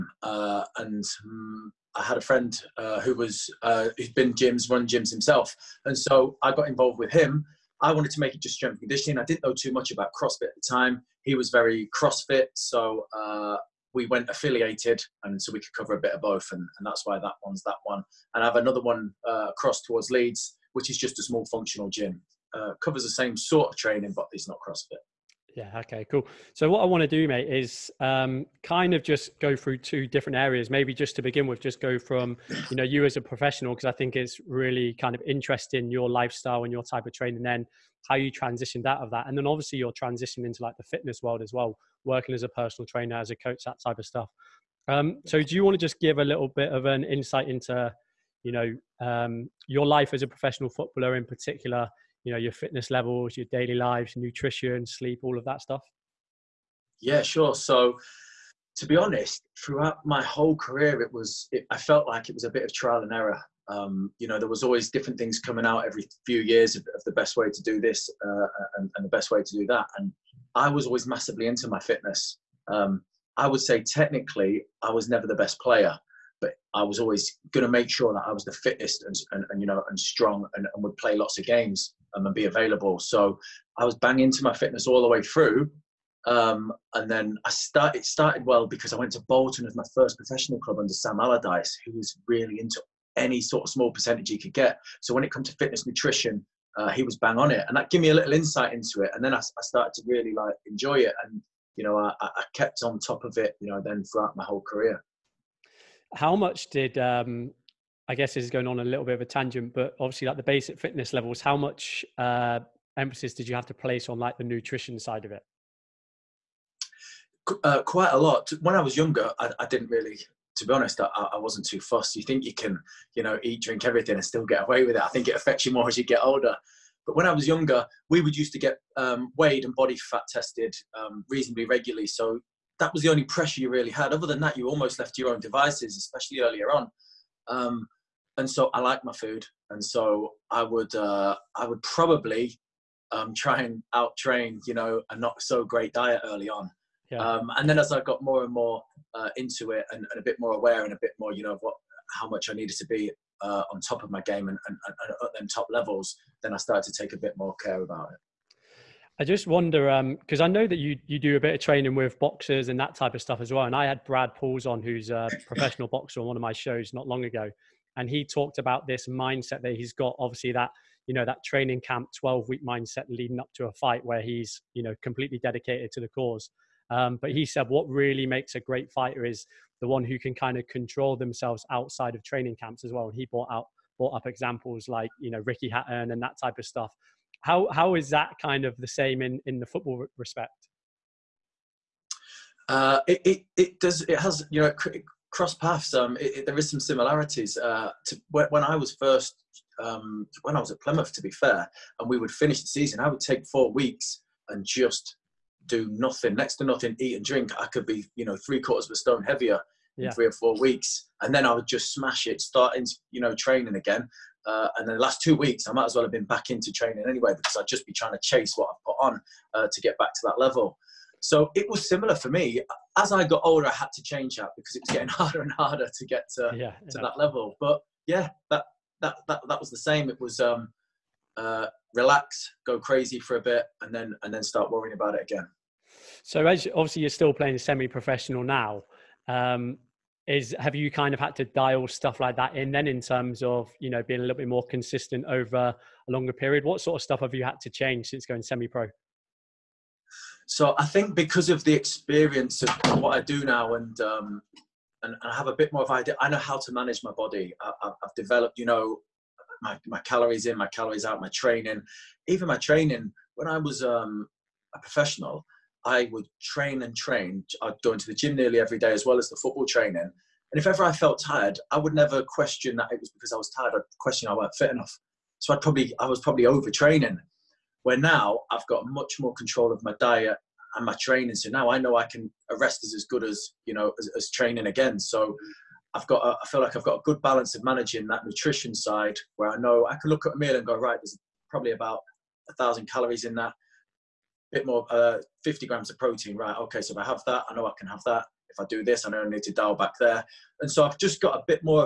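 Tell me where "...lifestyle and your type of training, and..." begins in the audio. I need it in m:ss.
0:36.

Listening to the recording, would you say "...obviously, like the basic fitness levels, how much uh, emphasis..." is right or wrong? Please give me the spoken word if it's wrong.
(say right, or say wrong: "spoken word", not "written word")
right.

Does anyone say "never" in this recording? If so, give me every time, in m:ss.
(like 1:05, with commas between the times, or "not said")
1:15, 4:31.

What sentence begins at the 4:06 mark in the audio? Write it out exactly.
What sort of stuff have you had to change since going semi-pro?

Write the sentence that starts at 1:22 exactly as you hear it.
So I was bang into my fitness all the way through.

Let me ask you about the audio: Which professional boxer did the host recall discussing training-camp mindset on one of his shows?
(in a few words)
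Brad Pauls.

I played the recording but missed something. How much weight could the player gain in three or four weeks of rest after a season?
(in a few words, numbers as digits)
three quarters of a stone.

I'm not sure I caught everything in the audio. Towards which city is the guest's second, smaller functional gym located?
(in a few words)
Leeds.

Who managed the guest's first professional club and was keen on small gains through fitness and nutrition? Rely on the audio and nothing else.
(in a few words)
Sam Allardyce.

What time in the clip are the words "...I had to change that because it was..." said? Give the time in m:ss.
3:43.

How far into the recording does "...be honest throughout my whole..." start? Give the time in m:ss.
0:58.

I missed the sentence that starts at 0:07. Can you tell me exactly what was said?
I wanted to make it just strength conditioning.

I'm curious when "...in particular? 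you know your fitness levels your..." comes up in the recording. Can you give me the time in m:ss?
0:51.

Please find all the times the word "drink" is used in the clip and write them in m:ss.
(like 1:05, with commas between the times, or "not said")
2:03, 3:27.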